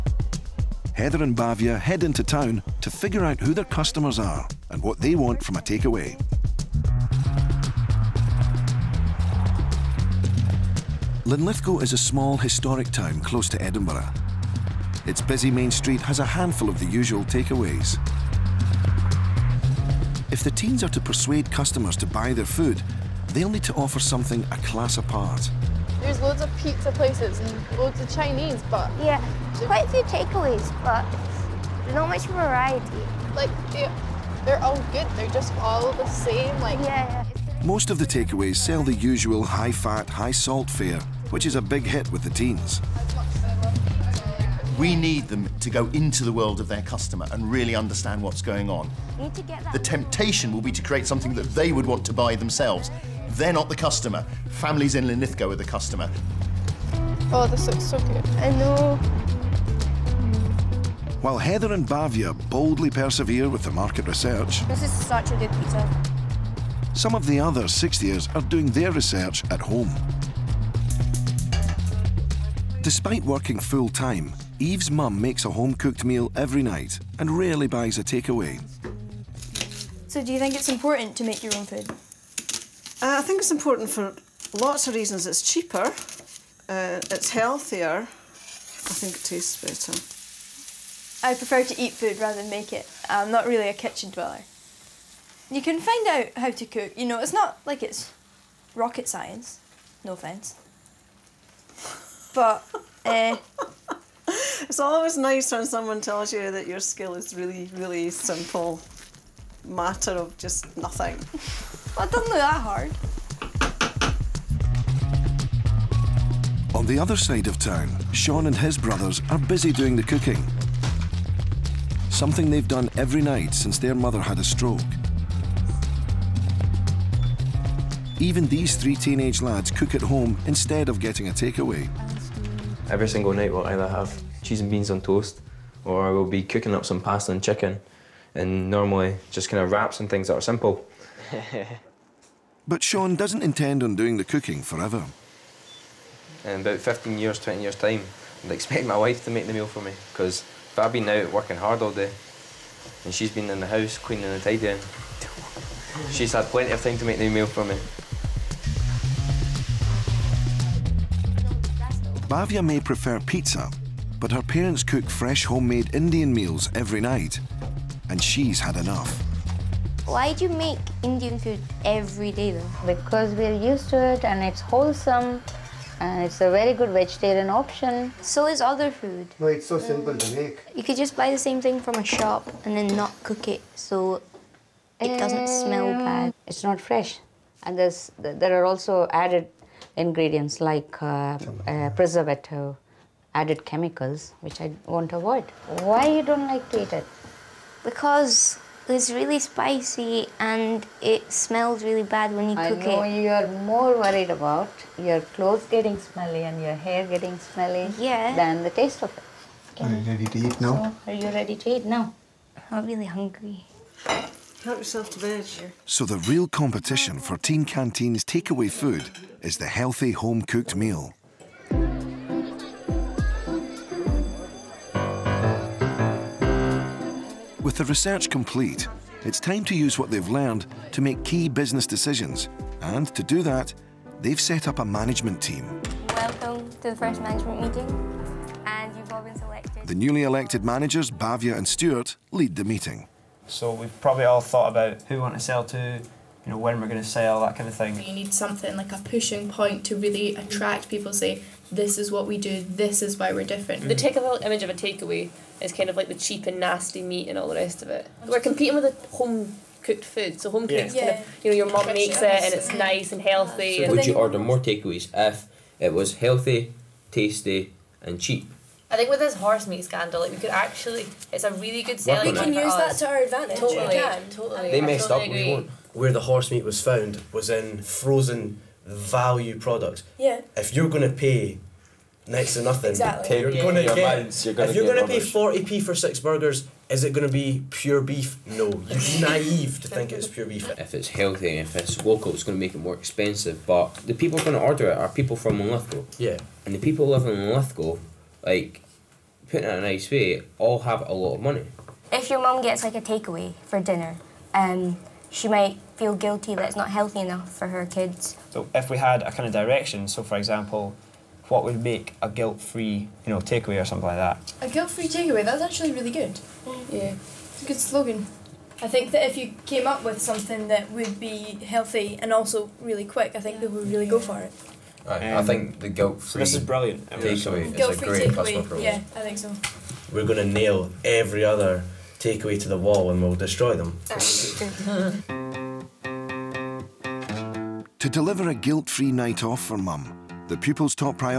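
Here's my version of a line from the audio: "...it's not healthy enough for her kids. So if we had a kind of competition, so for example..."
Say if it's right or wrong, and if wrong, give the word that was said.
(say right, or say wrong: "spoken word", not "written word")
wrong: "direction", not "competition".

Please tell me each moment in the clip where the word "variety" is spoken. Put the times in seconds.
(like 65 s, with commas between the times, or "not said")
32 s.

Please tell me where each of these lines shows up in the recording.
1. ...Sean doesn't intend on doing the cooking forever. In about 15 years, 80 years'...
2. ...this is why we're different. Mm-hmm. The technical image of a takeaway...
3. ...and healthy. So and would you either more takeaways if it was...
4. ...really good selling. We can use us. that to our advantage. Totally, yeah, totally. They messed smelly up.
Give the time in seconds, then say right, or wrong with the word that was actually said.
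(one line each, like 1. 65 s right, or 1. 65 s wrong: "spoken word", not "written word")
1. 142 s wrong: "20", not "80"
2. 252 s right
3. 263 s wrong: "order", not "either"
4. 271 s wrong: "totally", not "smelly".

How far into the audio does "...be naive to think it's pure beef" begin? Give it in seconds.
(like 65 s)
288 s.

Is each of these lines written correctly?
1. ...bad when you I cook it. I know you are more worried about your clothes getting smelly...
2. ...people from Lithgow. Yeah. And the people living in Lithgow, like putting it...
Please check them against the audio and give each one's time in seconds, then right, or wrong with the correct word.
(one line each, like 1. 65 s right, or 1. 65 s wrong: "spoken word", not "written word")
1. 202 s right
2. 295 s right.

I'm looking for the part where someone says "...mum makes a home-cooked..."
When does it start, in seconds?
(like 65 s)
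74 s.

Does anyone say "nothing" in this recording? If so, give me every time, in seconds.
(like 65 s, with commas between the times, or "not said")
110 s, 282 s.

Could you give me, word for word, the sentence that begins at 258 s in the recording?
We're competing with a home cooked food.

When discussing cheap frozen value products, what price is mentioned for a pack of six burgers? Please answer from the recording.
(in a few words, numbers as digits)
40p.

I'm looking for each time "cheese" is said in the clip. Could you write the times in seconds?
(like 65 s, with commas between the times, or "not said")
134 s.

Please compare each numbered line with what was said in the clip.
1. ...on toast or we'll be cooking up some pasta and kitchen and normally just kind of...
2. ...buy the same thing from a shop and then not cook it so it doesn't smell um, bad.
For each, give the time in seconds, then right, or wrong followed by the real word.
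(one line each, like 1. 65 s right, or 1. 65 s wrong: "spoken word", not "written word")
1. 134 s wrong: "chicken", not "kitchen"
2. 181 s right.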